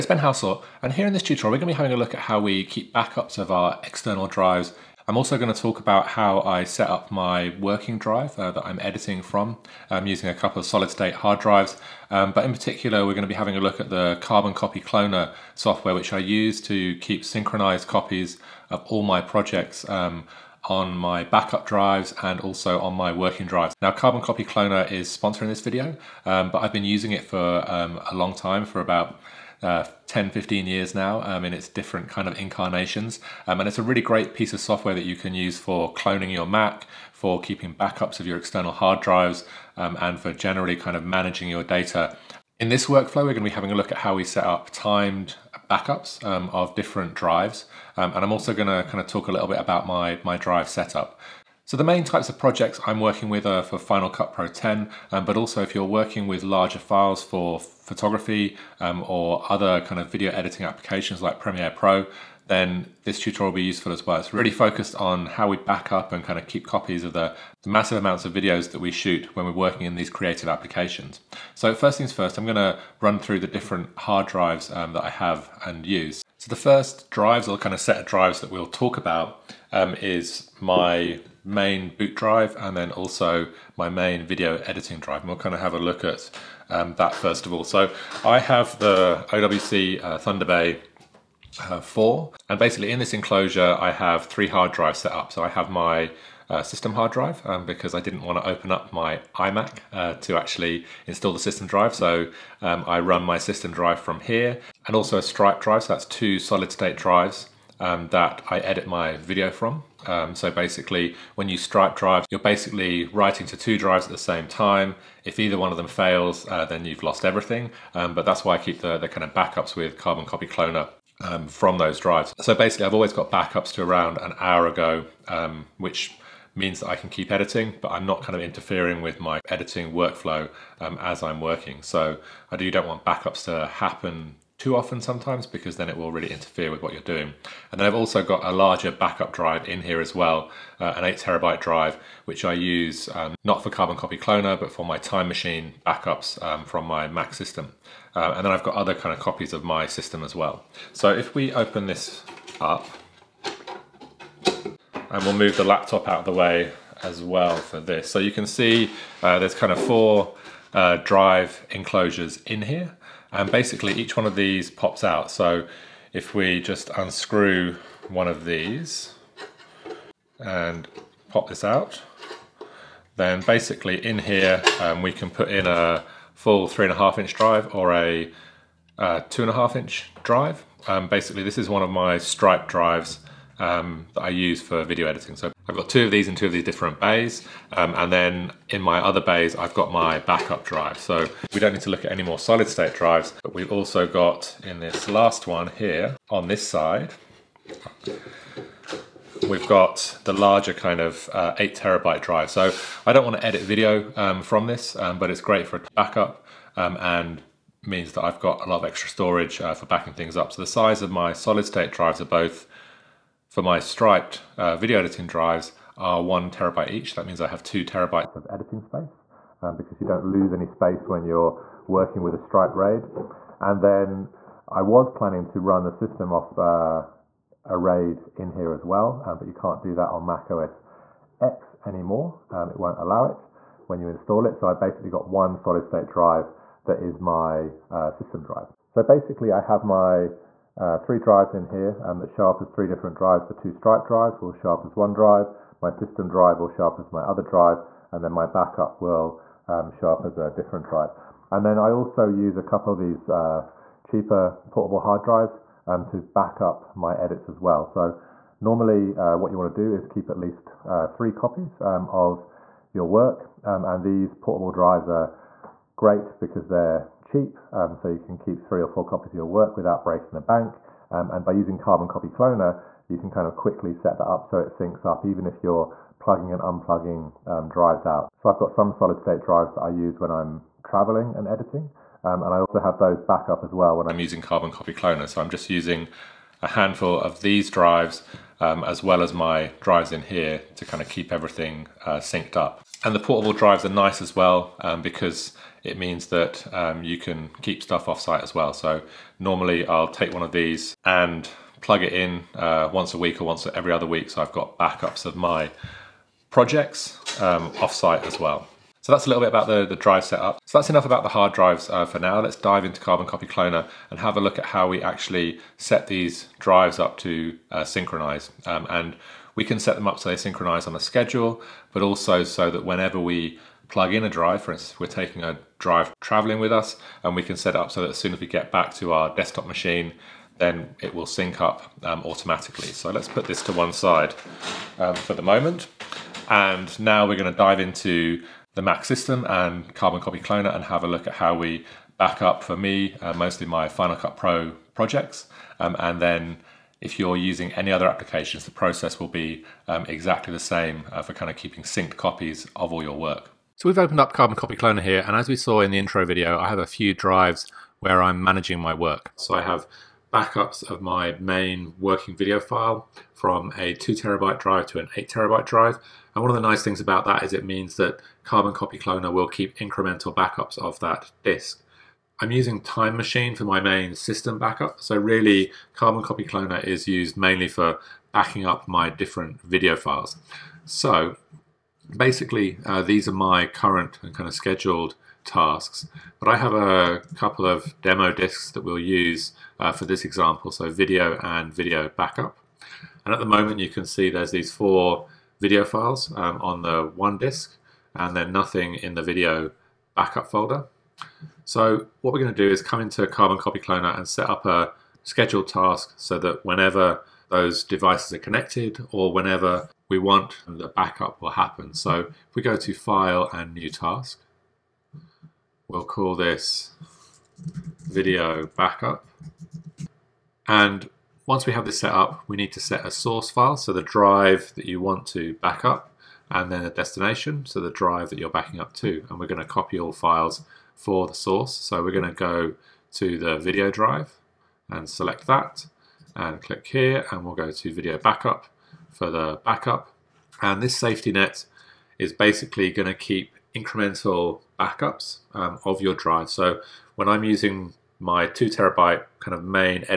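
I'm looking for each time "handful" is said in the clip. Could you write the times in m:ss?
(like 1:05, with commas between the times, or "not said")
4:46.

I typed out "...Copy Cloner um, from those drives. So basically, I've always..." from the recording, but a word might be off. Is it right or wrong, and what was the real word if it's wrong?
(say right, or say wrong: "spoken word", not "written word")
right.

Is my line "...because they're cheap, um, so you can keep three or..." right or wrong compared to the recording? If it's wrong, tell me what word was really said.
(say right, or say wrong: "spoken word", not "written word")
right.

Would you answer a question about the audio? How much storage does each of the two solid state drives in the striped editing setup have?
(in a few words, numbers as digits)
1 terabyte.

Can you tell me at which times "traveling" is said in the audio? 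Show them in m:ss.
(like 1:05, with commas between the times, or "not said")
4:40, 5:26.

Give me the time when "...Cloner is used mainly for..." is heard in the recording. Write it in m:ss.
6:16.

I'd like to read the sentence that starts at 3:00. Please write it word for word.
Um, basically this is one of my Stripe drives um, that I use for video editing.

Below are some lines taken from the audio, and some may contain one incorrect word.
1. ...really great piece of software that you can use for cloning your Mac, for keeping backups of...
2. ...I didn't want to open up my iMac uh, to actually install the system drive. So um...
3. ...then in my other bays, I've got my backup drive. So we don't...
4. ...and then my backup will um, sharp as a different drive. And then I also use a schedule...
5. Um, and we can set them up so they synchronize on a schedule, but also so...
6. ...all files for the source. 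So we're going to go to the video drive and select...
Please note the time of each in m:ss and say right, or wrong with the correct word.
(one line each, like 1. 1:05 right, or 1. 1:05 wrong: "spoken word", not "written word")
1. 0:33 right
2. 1:37 right
3. 3:08 right
4. 4:08 wrong: "couple", not "schedule"
5. 5:18 right
6. 7:09 right.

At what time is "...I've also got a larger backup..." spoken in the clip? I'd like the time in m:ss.
2:17.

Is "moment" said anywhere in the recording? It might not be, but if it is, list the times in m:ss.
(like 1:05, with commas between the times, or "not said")
5:35, 6:33.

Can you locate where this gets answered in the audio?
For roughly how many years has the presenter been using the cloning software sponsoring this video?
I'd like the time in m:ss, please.
0:30.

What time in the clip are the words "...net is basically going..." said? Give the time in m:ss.
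7:21.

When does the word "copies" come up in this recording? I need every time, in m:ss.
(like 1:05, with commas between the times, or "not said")
0:17, 1:06, 2:29, 4:21, 4:29, 5:52.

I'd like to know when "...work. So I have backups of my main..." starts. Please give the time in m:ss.
5:58.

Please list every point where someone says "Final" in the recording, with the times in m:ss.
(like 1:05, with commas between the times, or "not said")
0:53, 5:43.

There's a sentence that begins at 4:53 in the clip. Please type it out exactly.
And the portable drives are nice as well um, because it means that um, you can keep stuff off site as well.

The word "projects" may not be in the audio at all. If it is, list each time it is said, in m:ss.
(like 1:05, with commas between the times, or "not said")
0:19, 0:52, 5:06, 5:44.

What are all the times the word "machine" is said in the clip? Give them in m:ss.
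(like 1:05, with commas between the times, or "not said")
2:25, 5:29, 6:13.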